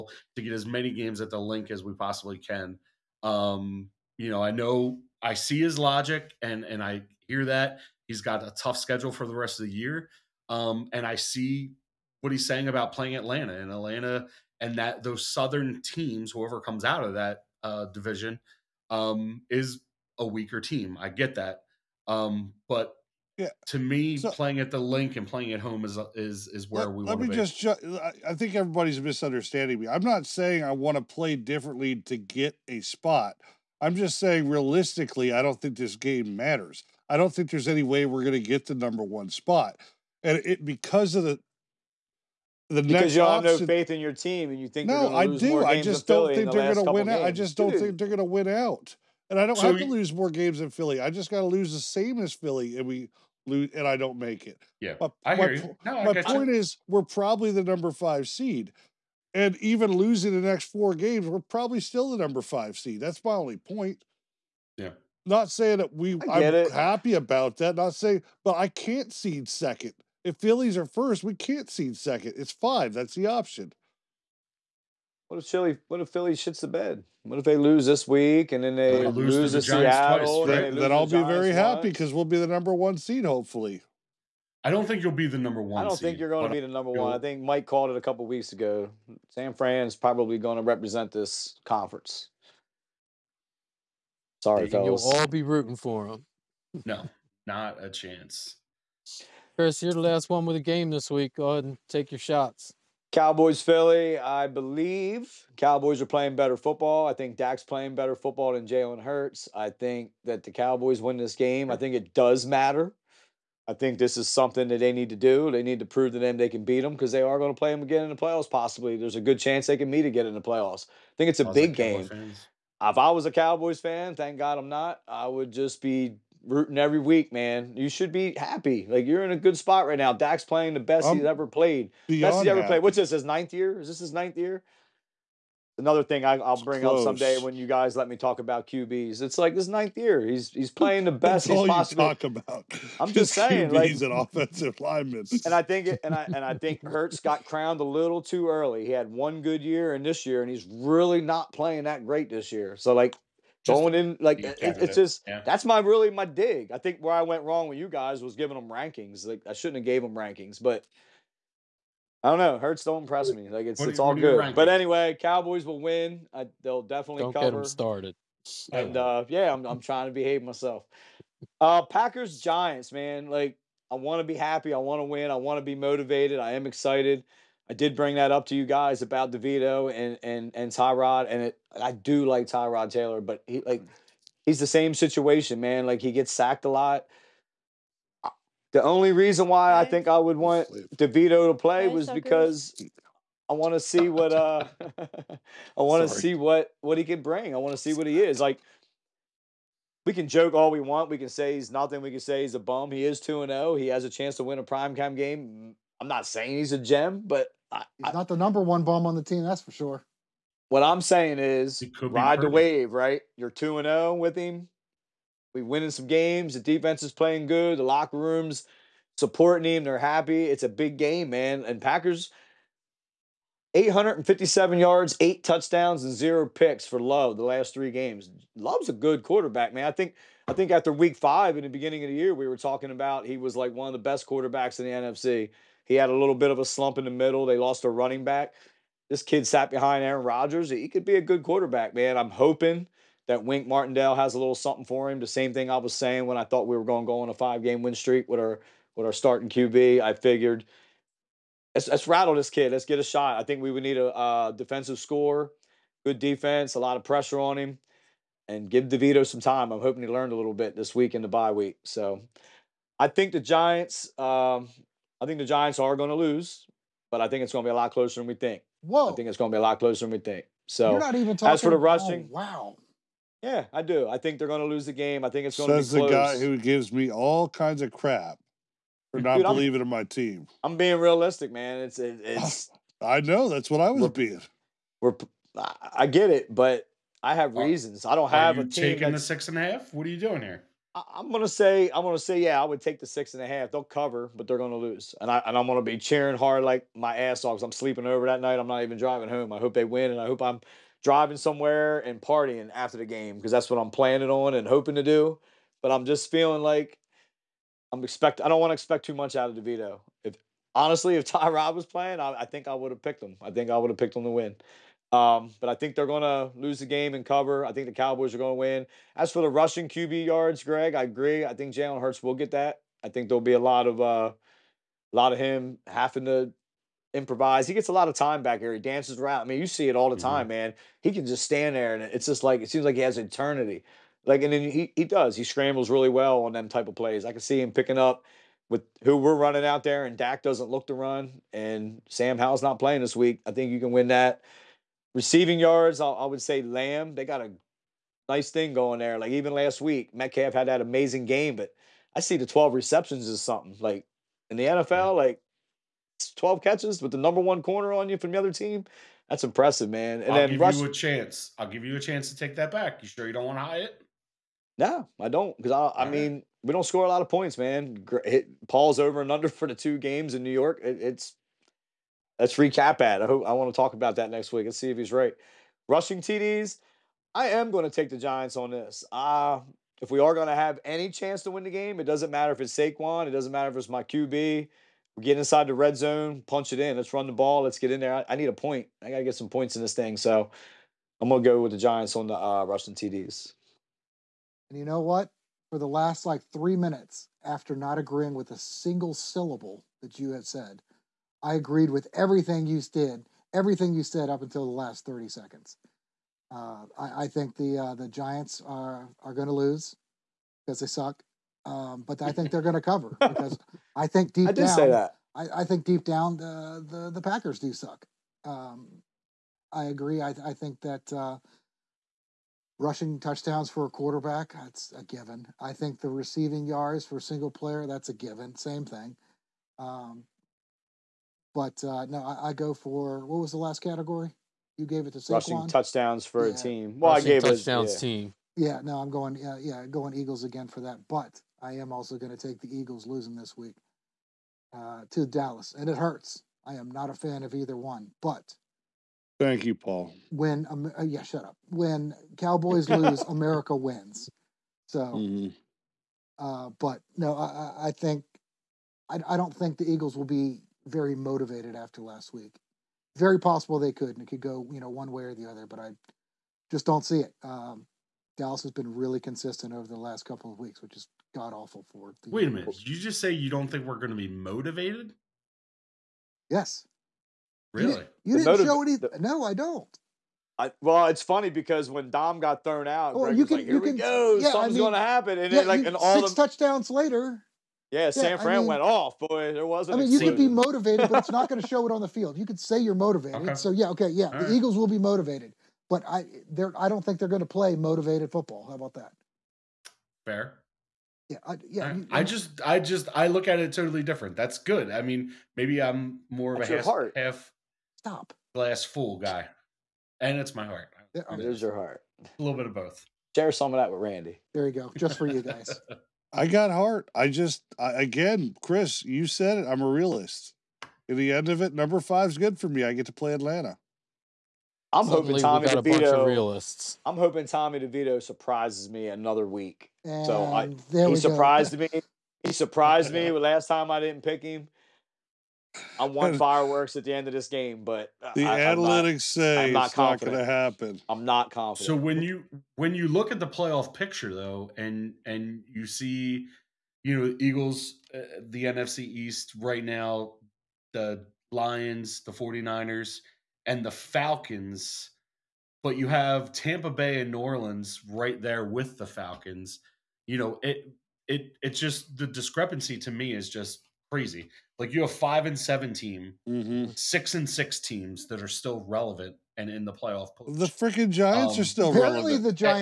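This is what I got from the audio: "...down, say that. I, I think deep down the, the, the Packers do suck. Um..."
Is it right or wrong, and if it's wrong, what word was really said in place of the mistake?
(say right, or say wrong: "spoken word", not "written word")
right.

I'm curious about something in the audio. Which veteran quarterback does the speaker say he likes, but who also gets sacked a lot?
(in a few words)
Tyrod Taylor.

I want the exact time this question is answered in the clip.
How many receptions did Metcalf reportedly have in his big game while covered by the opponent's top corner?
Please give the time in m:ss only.
5:52.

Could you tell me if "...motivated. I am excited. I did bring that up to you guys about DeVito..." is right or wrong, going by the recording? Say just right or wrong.
right.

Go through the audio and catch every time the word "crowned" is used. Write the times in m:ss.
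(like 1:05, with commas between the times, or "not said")
2:27.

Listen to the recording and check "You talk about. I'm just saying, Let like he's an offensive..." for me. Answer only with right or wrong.
wrong.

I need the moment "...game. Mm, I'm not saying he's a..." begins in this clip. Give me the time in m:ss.
3:25.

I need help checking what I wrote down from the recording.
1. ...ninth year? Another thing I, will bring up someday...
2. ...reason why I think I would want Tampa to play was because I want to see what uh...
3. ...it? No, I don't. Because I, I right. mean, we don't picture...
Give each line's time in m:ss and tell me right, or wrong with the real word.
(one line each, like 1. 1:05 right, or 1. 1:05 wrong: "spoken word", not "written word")
1. 2:14 right
2. 3:09 wrong: "DeVito", not "Tampa"
3. 6:03 wrong: "score", not "picture".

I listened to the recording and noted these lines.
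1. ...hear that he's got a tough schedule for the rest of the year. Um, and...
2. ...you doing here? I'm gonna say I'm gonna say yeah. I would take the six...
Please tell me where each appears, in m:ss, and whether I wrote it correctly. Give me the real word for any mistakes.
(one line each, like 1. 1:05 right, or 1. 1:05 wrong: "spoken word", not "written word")
1. 0:07 right
2. 4:50 right.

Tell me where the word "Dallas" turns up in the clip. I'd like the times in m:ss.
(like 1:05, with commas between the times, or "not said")
7:25, 7:48.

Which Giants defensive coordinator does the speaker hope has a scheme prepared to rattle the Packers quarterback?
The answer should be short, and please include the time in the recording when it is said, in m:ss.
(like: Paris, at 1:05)
Wink Martindale, at 4:03.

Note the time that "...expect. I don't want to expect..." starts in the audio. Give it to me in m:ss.
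5:08.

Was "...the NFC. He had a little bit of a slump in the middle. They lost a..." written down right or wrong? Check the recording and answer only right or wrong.
right.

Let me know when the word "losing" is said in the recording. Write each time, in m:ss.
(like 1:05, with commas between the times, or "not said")
0:59, 7:23.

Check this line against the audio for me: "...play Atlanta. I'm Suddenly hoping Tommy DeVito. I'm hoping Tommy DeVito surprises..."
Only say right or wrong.
right.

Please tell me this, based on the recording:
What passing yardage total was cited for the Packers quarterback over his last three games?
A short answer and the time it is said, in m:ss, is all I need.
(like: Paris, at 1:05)
857 yards, at 3:43.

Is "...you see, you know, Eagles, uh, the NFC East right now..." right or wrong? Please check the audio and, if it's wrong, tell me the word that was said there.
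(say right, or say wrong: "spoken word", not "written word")
right.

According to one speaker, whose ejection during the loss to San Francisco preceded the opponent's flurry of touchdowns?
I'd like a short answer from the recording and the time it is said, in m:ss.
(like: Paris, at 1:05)
Dom, at 8:01.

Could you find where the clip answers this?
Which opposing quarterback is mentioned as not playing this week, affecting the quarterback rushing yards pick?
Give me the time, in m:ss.
5:42.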